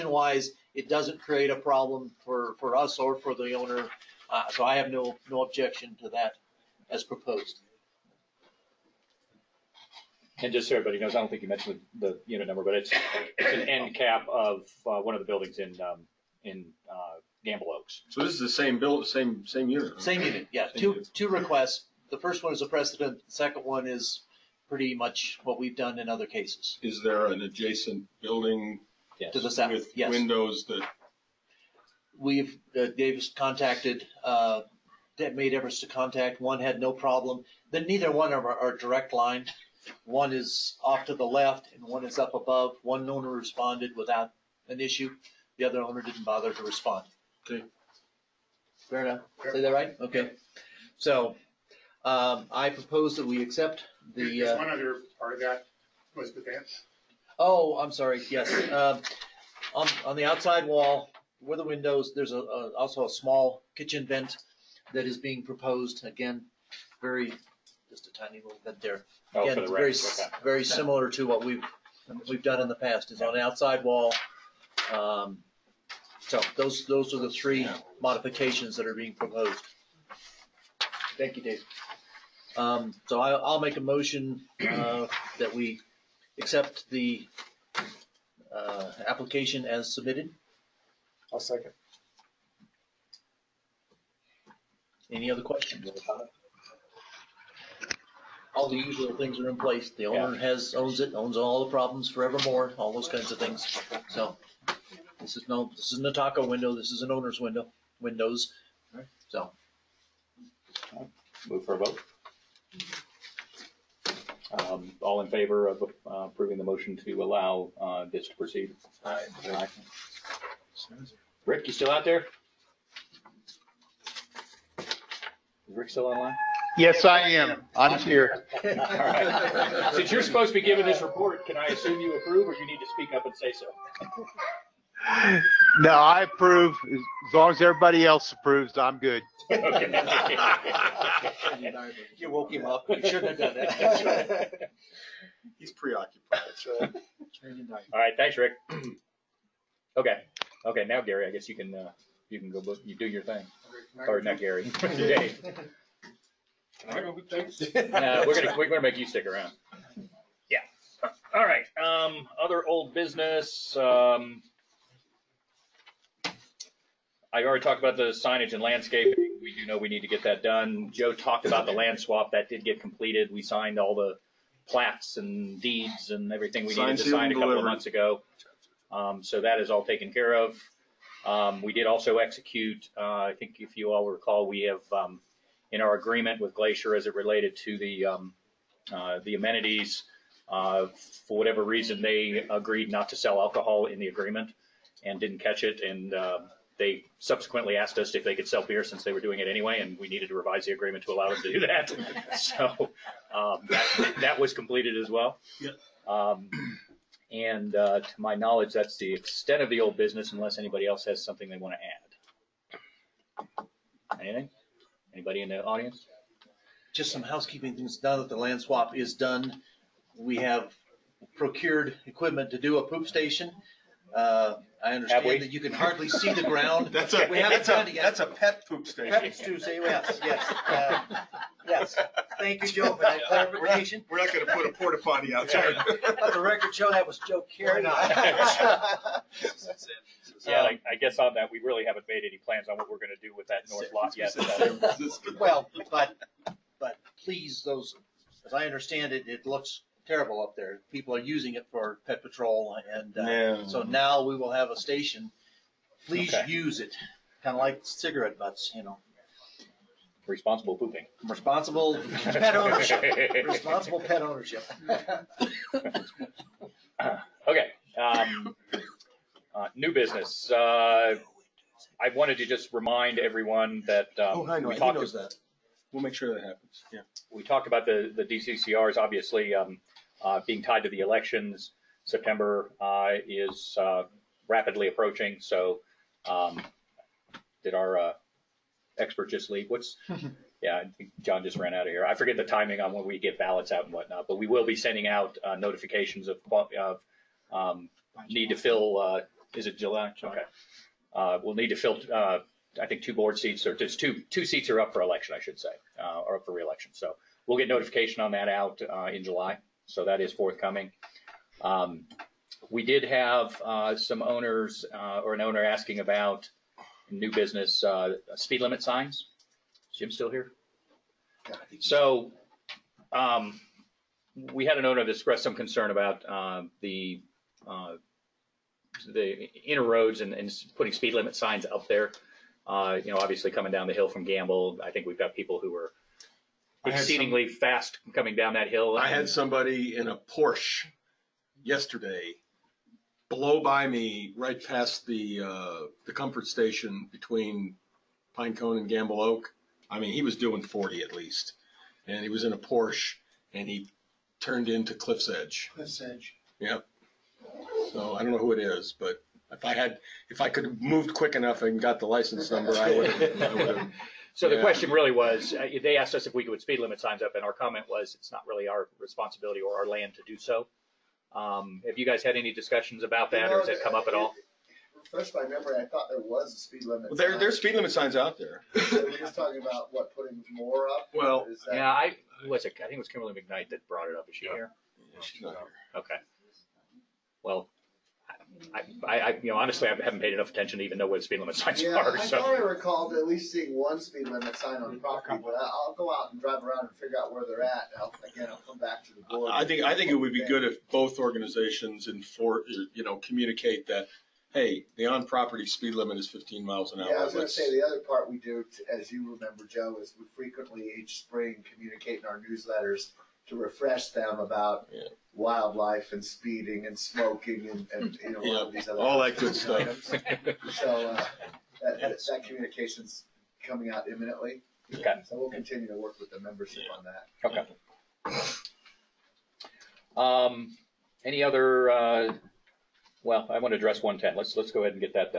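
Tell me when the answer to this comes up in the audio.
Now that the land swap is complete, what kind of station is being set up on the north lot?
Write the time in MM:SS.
03:48.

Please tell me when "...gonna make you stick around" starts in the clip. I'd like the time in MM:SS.
02:38.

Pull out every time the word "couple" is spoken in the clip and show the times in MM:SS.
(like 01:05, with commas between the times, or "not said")
02:57.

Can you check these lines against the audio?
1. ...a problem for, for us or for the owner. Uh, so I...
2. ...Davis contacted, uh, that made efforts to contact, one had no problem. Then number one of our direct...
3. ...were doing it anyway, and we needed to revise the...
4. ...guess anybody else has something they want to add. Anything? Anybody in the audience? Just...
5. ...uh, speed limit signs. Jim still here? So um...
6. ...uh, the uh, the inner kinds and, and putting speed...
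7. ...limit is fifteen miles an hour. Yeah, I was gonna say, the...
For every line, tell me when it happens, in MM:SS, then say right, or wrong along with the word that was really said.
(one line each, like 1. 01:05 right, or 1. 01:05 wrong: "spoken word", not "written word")
1. 00:01 right
2. 00:32 wrong: "neither", not "number"
3. 03:19 right
4. 03:30 wrong: "unless", not "guess"
5. 05:17 right
6. 05:26 wrong: "roads", not "kinds"
7. 06:45 right.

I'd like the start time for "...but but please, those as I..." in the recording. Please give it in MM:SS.
04:05.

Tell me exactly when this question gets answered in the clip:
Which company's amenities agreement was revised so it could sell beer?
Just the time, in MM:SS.
03:06.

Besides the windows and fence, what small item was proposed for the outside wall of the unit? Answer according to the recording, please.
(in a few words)
Kitchen vent.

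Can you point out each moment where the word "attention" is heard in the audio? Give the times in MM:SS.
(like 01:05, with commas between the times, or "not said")
06:30.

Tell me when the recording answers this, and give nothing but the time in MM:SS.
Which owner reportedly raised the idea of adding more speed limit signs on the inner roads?
06:23.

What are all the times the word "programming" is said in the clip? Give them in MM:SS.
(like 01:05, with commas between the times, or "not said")
not said.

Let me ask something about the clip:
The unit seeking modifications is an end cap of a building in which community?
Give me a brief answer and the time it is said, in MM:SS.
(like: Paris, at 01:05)
Gamble Oaks, at 00:17.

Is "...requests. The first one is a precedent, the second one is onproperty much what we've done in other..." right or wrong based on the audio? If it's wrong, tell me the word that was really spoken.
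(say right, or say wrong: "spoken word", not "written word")
wrong: "pretty", not "onproperty".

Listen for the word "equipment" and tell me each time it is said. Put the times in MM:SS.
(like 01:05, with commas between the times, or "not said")
03:42.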